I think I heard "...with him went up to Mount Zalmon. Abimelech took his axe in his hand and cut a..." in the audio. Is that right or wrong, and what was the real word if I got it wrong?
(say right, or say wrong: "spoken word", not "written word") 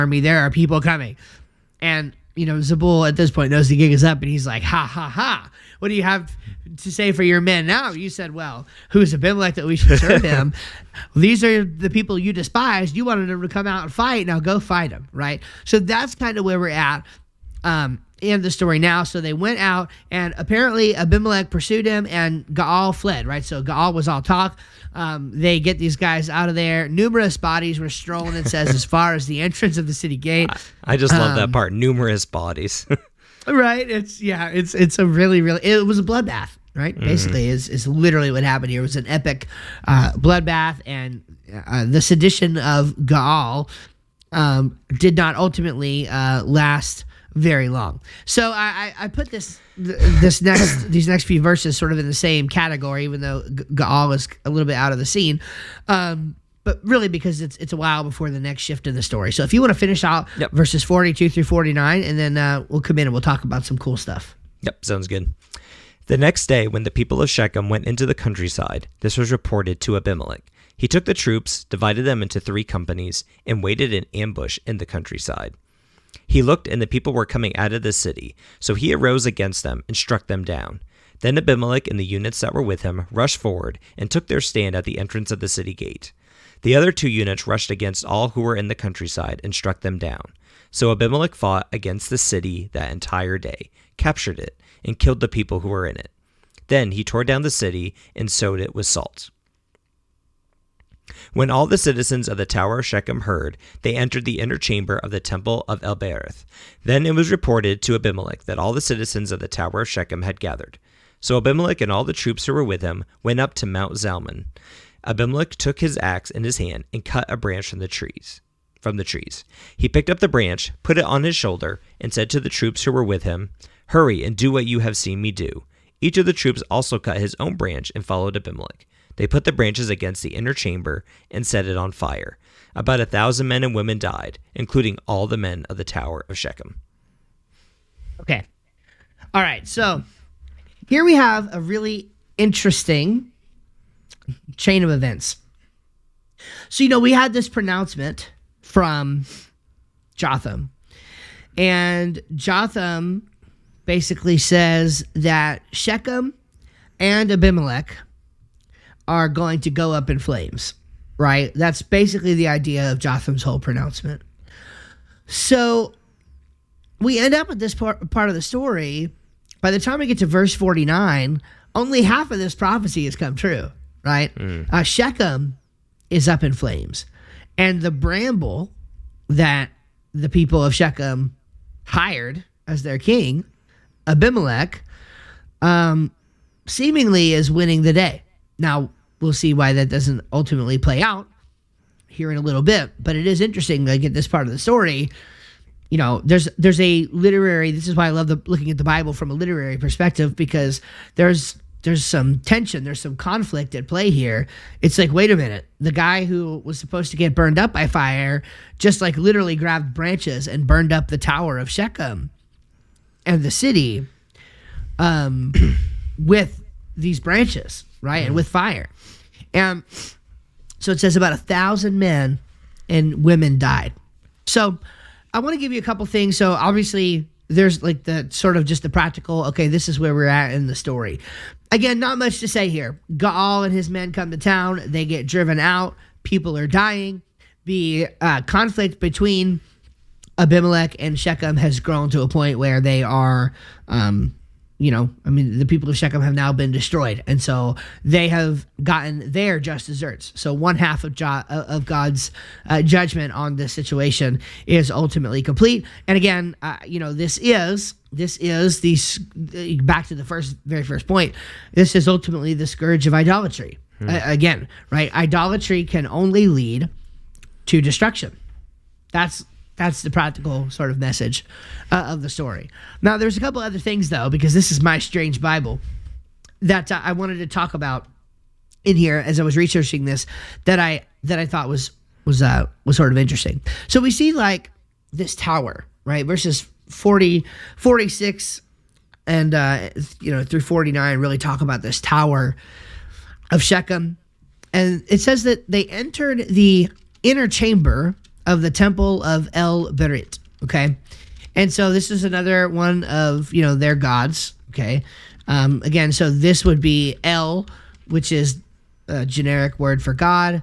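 right.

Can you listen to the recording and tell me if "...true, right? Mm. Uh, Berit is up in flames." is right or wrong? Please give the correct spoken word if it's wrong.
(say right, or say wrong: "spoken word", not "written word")
wrong: "Shechem", not "Berit".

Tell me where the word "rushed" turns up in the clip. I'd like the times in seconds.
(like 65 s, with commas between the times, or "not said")
83 s, 87 s.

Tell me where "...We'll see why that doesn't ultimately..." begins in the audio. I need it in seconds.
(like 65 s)
189 s.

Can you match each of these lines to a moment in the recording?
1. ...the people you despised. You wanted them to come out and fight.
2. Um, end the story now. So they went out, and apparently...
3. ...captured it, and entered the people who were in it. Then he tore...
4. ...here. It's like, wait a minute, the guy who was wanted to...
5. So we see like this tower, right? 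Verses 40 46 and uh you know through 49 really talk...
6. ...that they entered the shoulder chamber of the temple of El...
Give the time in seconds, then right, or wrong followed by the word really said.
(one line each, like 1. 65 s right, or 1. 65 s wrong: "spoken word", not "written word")
1. 11 s right
2. 17 s right
3. 93 s wrong: "killed", not "entered"
4. 204 s wrong: "supposed", not "wanted"
5. 283 s right
6. 295 s wrong: "inner", not "shoulder".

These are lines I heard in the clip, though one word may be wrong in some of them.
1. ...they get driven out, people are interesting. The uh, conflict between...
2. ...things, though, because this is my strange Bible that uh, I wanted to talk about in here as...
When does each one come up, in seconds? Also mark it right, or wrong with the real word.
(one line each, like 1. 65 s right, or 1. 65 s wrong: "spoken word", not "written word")
1. 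234 s wrong: "dying", not "interesting"
2. 273 s right.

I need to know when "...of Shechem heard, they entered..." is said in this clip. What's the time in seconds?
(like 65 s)
102 s.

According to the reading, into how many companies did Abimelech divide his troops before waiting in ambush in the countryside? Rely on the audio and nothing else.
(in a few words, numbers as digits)
3.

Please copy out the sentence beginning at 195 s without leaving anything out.
You know, there's there's a literary.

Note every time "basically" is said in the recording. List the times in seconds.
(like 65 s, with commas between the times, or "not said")
37 s, 153 s, 161 s.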